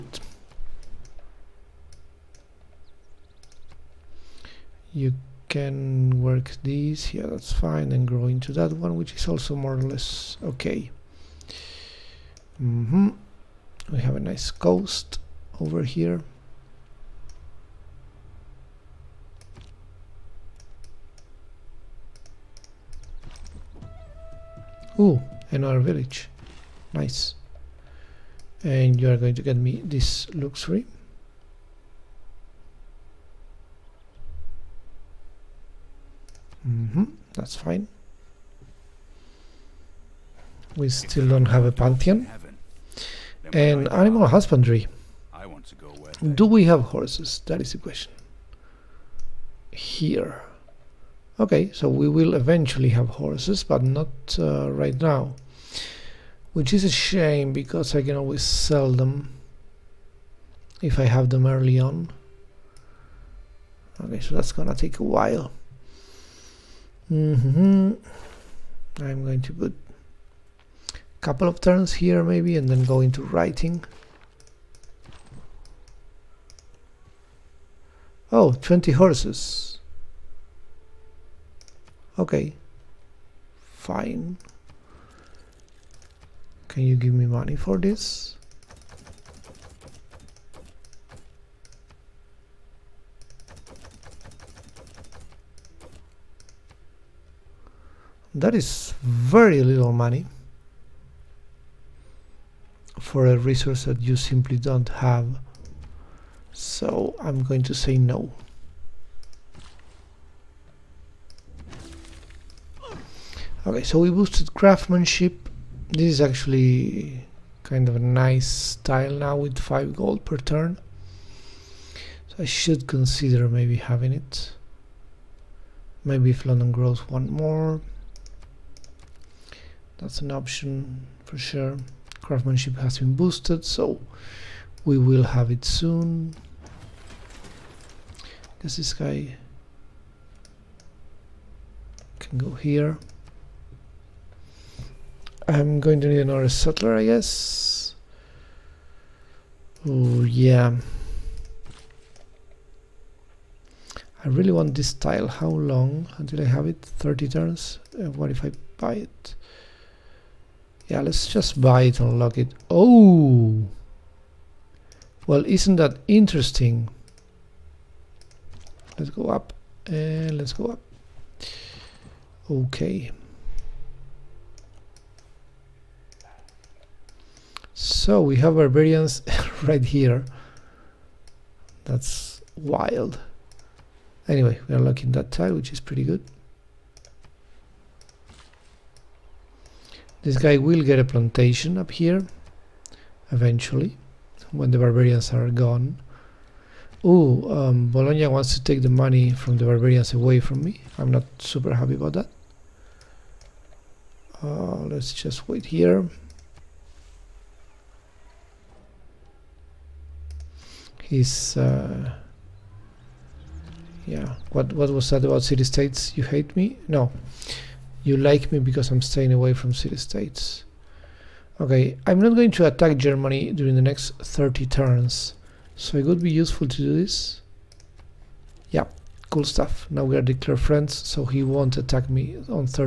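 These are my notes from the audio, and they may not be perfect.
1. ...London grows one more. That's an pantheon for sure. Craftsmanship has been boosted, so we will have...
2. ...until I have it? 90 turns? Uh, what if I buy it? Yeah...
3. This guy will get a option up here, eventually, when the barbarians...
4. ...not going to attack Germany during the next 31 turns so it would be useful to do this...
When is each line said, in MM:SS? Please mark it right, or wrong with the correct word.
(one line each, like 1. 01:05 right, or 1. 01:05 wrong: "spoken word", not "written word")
1. 02:06 wrong: "option", not "pantheon"
2. 02:36 wrong: "30", not "90"
3. 03:10 wrong: "plantation", not "option"
4. 03:42 wrong: "30", not "31".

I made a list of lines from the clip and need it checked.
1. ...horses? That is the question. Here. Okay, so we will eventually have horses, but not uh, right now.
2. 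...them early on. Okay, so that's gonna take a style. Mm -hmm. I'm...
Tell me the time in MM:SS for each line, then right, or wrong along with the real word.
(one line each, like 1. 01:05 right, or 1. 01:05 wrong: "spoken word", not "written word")
1. 00:46 right
2. 01:01 wrong: "while", not "style".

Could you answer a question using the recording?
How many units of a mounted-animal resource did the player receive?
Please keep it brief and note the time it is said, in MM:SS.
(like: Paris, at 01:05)
20, at 01:18.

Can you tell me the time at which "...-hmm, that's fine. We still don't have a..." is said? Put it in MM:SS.
00:36.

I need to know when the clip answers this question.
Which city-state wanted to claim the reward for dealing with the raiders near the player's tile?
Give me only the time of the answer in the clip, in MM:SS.
03:17.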